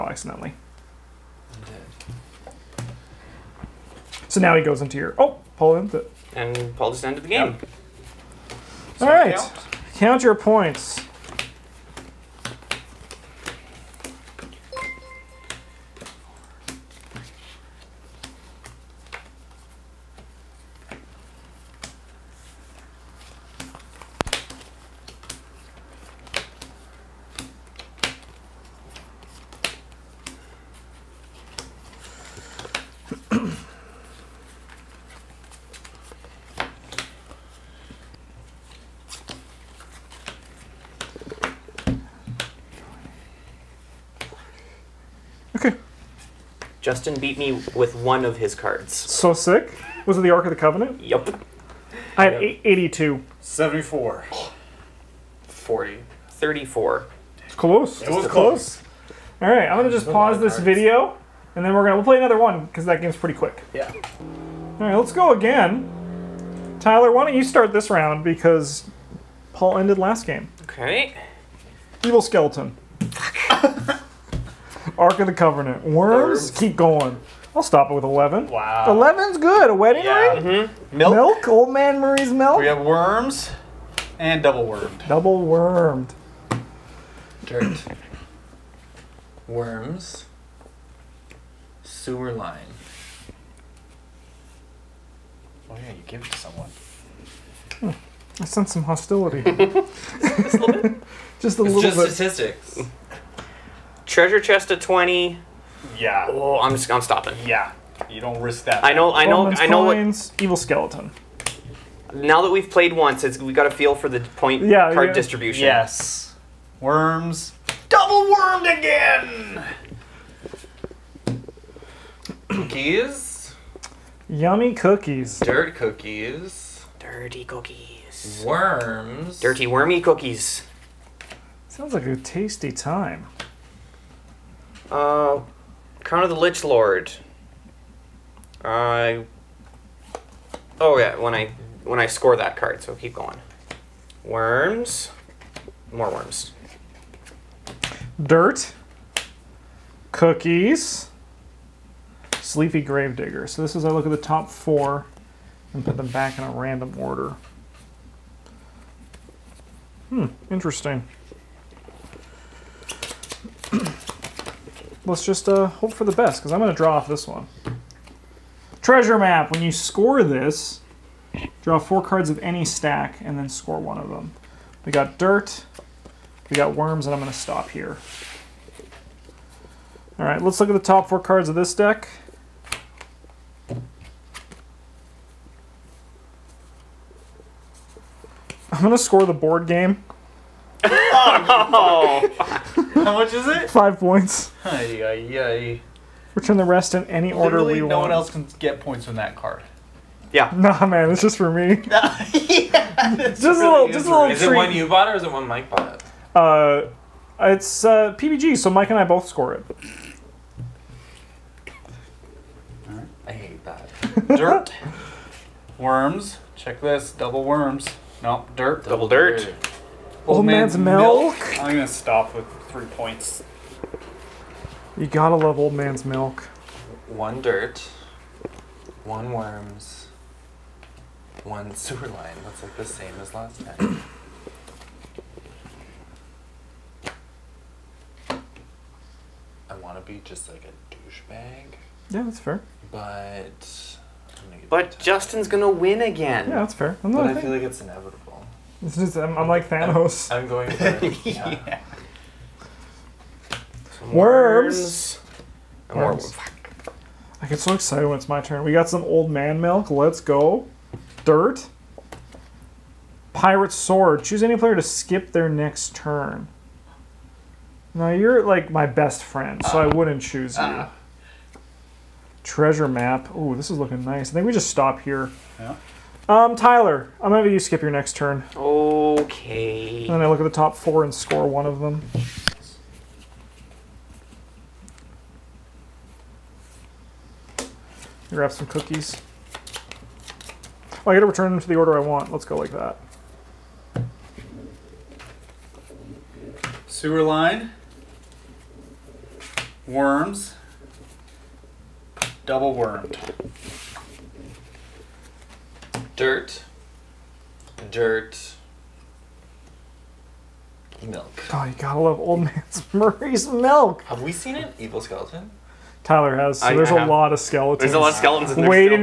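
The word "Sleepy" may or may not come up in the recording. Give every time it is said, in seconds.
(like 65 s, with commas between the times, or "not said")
152 s.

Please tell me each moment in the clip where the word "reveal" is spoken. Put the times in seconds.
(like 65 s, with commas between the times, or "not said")
not said.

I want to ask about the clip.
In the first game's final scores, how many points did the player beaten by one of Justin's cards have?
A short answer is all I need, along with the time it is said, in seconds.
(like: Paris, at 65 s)
82, at 52 s.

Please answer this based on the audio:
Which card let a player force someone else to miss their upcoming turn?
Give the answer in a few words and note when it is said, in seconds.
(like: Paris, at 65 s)
Pirate sword, at 263 s.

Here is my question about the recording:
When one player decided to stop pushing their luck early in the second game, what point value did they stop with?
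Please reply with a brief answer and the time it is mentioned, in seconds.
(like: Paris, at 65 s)
11, at 77 s.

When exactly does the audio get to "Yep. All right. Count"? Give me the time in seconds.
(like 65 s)
8 s.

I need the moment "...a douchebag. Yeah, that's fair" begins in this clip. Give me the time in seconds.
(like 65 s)
240 s.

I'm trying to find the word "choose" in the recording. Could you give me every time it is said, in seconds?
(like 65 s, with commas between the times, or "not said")
264 s, 270 s.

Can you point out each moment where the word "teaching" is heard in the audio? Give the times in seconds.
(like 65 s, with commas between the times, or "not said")
not said.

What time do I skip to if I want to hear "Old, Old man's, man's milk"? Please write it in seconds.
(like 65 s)
220 s.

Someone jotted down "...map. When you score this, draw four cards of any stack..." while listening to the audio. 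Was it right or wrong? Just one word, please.
right.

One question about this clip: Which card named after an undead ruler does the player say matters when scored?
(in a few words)
Crown of the Lich Lord.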